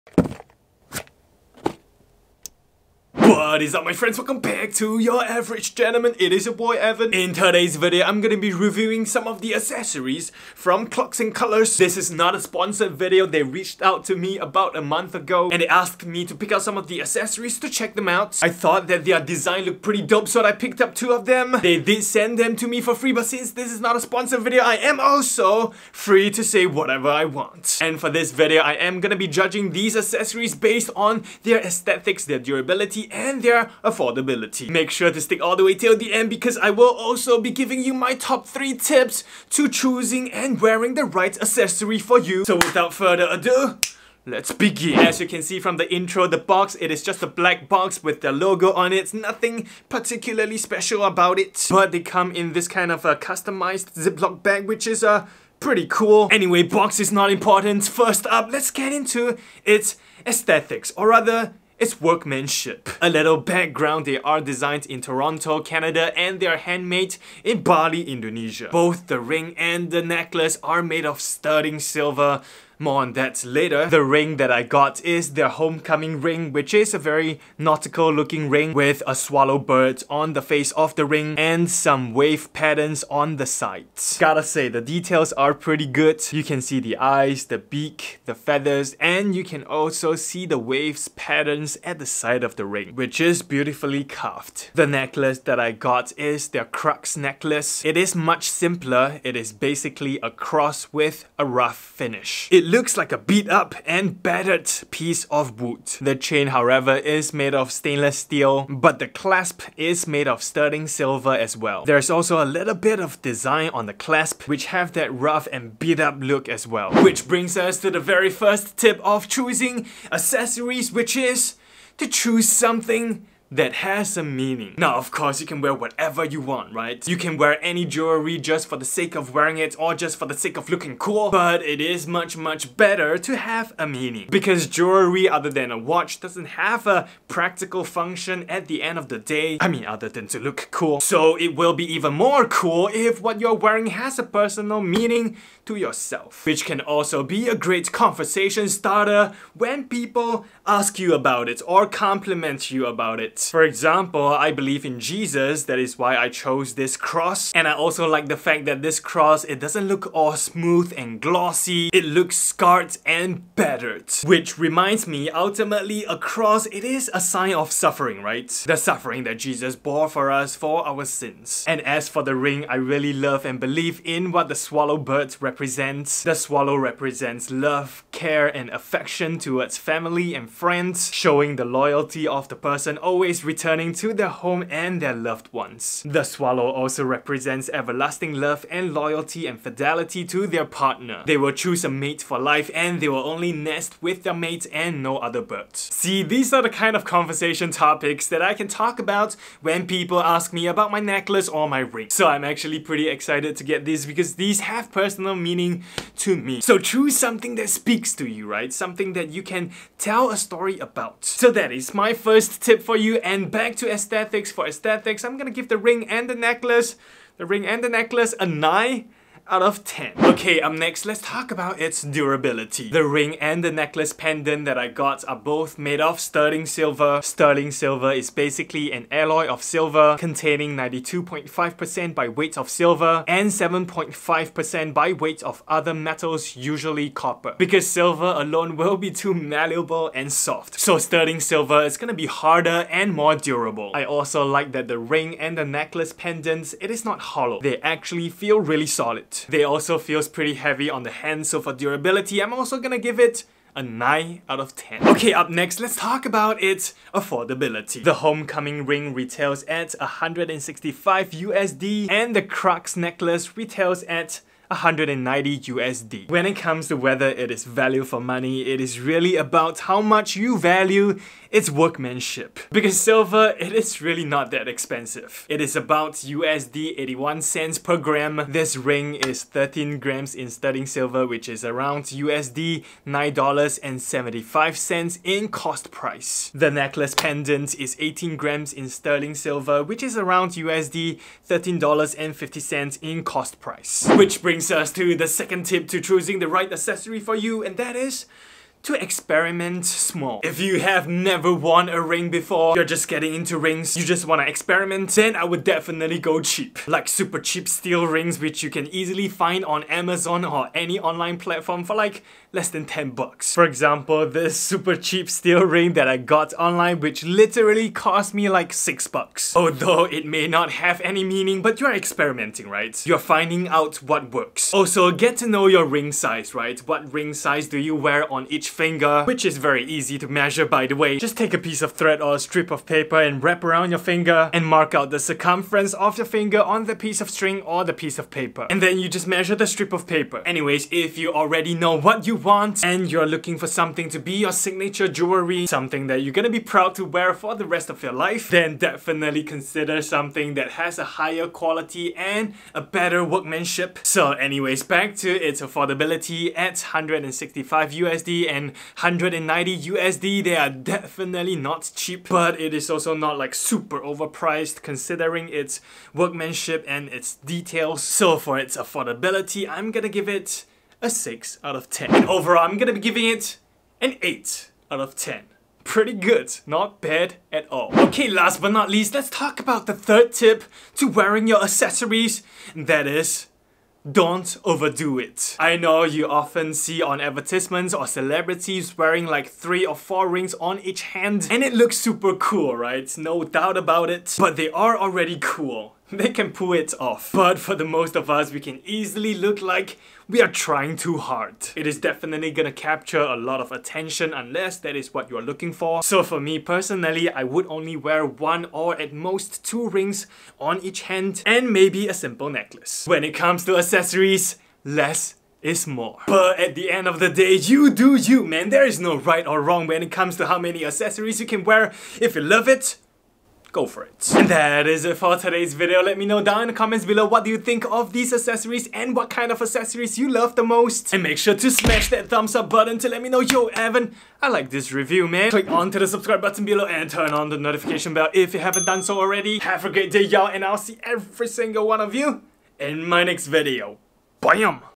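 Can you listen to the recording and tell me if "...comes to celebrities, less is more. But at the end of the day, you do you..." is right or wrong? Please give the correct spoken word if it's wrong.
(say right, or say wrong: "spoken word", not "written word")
wrong: "accessories", not "celebrities".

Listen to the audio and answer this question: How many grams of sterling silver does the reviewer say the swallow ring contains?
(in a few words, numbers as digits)
13 grams.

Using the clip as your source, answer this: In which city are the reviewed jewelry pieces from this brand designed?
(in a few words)
Toronto.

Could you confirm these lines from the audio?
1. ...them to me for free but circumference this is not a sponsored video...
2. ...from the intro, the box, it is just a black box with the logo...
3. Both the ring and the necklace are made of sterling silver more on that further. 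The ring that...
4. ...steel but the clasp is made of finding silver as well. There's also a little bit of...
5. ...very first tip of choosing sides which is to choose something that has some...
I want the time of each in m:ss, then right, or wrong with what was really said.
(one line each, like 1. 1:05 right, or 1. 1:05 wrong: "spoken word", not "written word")
1. 0:22 wrong: "since", not "circumference"
2. 0:45 right
3. 1:08 wrong: "later", not "further"
4. 1:48 wrong: "sterling", not "finding"
5. 1:57 wrong: "accessories", not "sides".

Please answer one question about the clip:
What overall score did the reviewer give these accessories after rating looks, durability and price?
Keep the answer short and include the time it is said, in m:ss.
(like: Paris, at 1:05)
8 out of 10, at 6:14.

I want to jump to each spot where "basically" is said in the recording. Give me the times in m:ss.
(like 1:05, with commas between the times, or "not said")
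1:39, 3:48.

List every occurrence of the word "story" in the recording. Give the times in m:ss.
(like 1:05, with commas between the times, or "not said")
3:30.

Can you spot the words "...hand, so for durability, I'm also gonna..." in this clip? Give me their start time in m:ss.
4:11.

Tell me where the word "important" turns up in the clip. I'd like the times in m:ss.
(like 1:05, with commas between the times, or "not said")
0:57.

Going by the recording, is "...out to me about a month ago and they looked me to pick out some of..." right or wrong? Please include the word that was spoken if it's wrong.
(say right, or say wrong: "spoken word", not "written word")
wrong: "asked", not "looked".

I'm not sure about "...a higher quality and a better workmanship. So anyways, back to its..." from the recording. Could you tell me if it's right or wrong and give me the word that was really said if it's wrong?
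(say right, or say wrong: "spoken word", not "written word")
right.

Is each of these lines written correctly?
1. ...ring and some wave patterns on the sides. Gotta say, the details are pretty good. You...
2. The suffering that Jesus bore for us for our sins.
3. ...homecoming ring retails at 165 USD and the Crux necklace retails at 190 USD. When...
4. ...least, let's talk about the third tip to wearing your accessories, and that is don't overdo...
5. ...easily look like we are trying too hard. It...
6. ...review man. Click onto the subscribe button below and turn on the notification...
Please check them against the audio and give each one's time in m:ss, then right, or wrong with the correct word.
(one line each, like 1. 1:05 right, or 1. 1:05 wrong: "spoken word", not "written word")
1. 1:21 right
2. 2:48 right
3. 4:18 right
4. 6:18 right
5. 6:38 right
6. 7:14 right.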